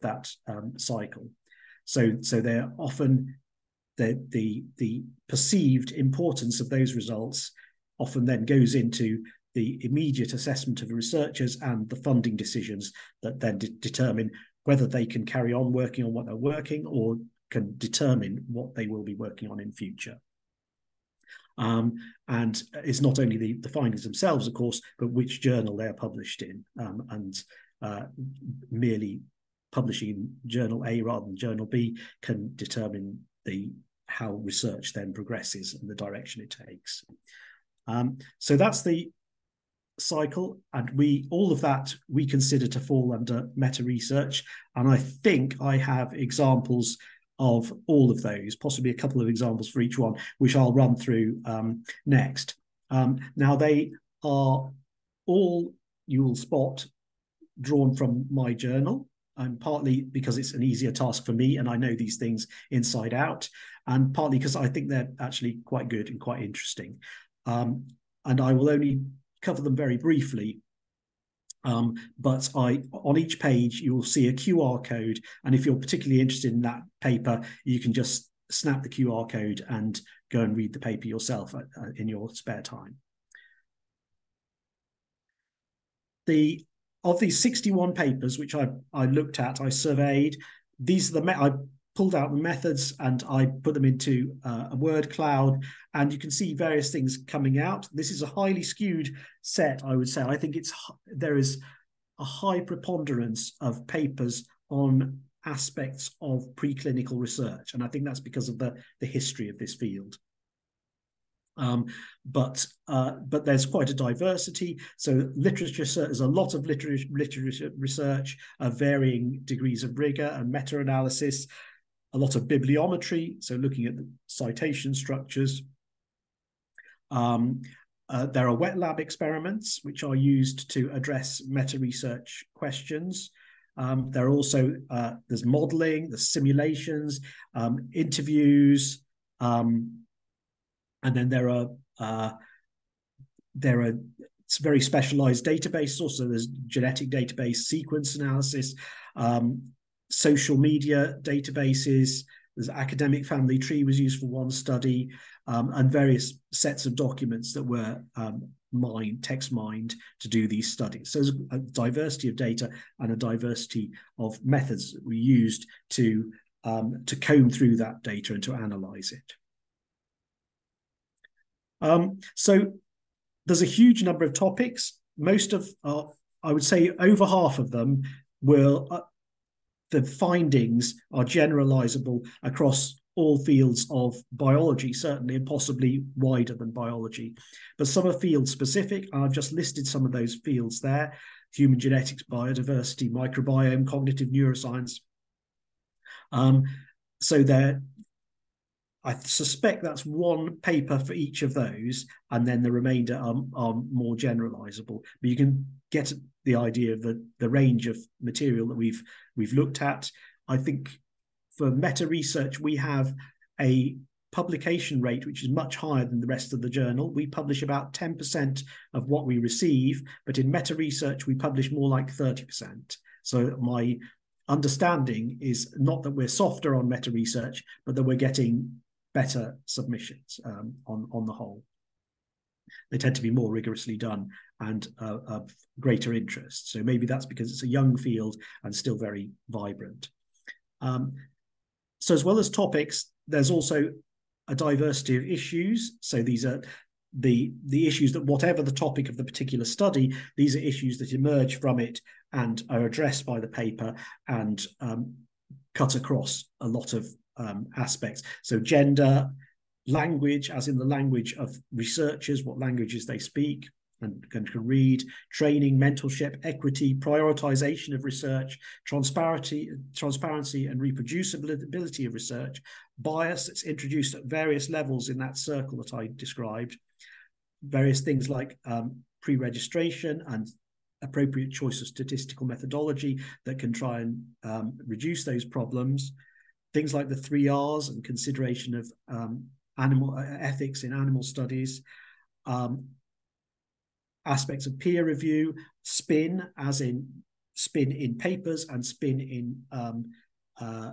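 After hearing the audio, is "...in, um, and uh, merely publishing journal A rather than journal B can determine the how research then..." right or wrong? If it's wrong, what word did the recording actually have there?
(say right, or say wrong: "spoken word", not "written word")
right.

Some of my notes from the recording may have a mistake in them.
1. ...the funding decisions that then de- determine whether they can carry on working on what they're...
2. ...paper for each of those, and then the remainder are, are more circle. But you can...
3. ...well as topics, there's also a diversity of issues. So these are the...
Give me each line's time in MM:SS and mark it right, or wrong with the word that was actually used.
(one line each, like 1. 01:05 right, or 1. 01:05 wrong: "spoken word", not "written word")
1. 00:11 right
2. 03:20 wrong: "generalizable", not "circle"
3. 04:02 right.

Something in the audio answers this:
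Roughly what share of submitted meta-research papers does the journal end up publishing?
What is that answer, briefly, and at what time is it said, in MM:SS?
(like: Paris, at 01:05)
30%, at 03:42.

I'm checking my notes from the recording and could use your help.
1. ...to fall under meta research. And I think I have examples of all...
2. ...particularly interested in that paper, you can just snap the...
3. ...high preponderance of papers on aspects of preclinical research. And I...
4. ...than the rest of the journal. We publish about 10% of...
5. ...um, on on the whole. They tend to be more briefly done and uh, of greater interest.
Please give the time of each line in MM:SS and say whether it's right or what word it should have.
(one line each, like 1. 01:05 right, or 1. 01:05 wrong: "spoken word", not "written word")
1. 00:42 right
2. 01:15 right
3. 01:42 right
4. 03:36 right
5. 03:50 wrong: "rigorously", not "briefly".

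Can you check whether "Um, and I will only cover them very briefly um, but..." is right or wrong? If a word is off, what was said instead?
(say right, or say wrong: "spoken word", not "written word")
right.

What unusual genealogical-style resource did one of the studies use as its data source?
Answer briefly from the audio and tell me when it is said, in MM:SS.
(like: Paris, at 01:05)
academic family tree, at 02:32.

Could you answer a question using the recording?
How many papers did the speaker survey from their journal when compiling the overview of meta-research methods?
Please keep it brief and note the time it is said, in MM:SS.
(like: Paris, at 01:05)
61, at 01:27.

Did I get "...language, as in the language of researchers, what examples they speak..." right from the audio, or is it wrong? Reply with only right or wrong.
wrong.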